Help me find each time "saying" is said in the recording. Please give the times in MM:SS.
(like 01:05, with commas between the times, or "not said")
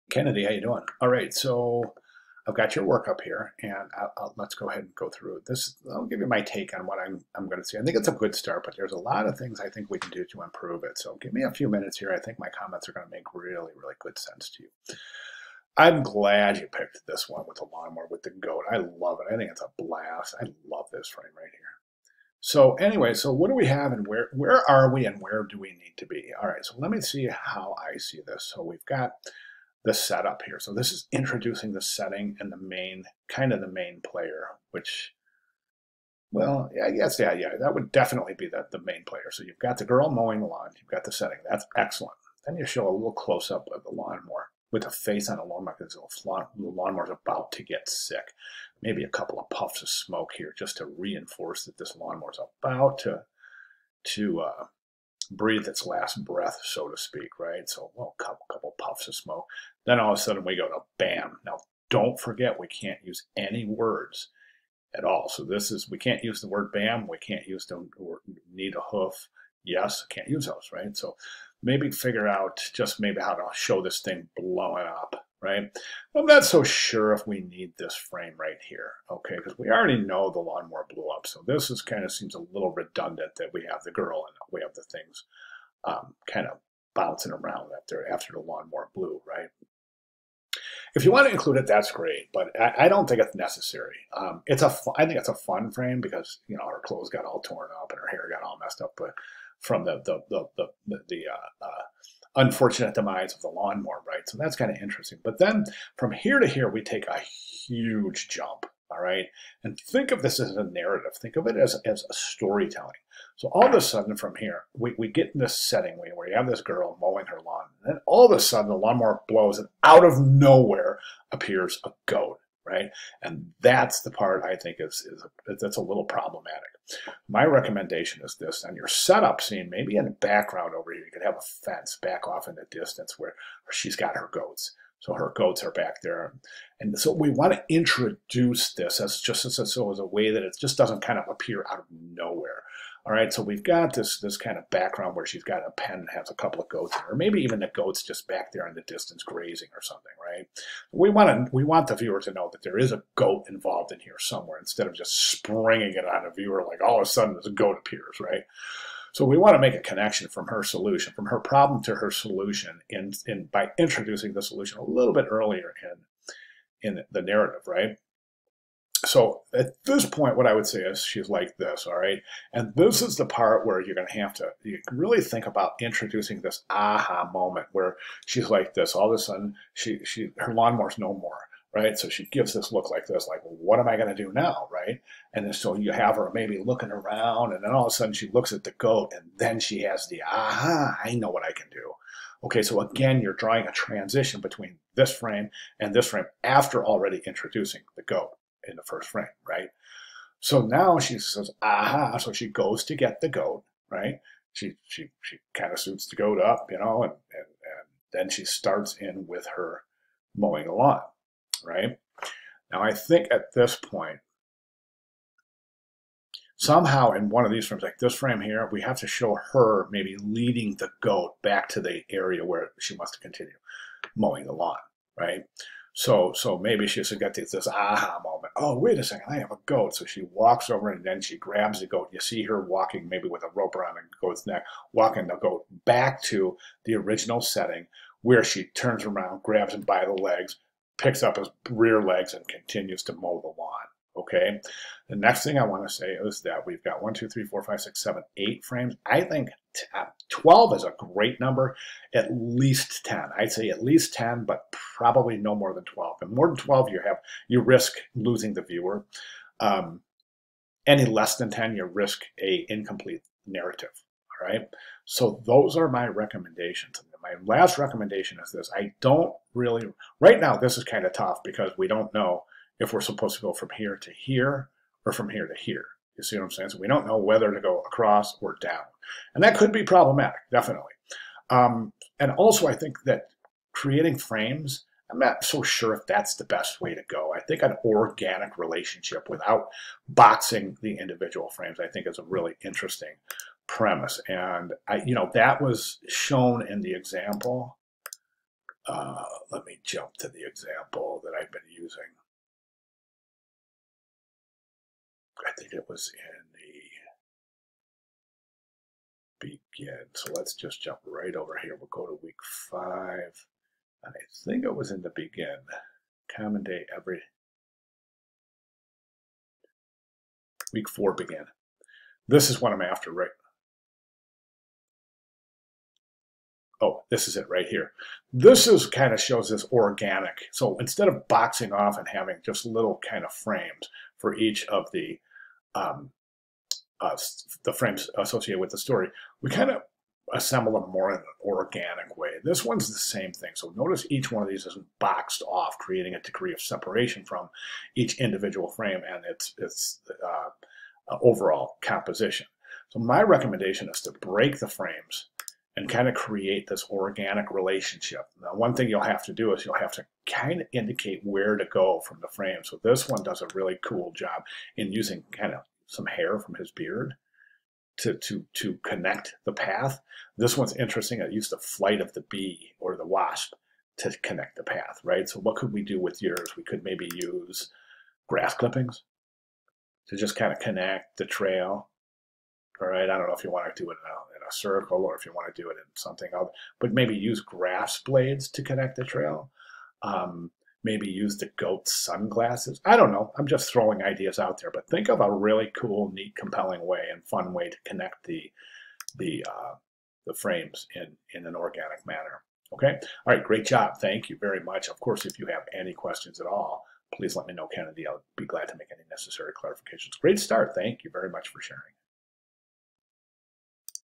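04:36.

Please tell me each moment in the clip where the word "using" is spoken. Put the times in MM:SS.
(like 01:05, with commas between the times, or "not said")
05:01, 06:04.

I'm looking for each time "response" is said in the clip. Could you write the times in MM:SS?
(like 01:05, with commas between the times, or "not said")
not said.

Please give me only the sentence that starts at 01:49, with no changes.
And think of this as a narrative.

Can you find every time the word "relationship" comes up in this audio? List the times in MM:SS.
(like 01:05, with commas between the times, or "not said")
04:48, 05:57.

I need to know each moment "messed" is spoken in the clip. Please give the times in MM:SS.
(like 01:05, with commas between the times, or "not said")
01:38.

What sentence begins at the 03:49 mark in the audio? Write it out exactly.
So she walks over and then she grabs the goat.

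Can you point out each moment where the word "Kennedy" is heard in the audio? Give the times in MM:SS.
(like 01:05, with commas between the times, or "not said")
00:00, 06:47.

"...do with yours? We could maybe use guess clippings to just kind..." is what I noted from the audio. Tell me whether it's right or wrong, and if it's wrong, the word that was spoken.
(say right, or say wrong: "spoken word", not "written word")
wrong: "grass", not "guess".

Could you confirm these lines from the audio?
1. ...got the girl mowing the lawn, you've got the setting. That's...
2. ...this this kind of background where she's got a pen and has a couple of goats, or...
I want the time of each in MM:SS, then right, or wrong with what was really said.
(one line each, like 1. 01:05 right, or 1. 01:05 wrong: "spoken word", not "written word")
1. 00:39 right
2. 02:23 right.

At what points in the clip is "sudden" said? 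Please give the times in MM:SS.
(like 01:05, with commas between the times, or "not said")
01:00, 01:53, 01:58, 02:37, 02:59, 03:07.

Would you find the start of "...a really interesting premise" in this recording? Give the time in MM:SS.
04:52.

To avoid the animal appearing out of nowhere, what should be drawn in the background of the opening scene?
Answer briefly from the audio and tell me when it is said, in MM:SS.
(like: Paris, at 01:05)
a fence, at 02:11.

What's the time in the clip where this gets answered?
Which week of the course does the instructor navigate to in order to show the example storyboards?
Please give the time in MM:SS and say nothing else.
05:12.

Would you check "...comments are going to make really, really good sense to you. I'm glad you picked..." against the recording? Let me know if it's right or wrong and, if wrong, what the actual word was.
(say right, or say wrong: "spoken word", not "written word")
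right.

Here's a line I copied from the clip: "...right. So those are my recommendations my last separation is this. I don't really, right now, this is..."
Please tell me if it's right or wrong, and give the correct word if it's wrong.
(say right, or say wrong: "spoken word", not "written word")
wrong: "recommendation", not "separation".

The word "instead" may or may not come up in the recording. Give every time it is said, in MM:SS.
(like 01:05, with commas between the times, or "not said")
02:34, 05:30.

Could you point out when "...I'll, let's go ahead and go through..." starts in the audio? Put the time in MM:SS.
00:04.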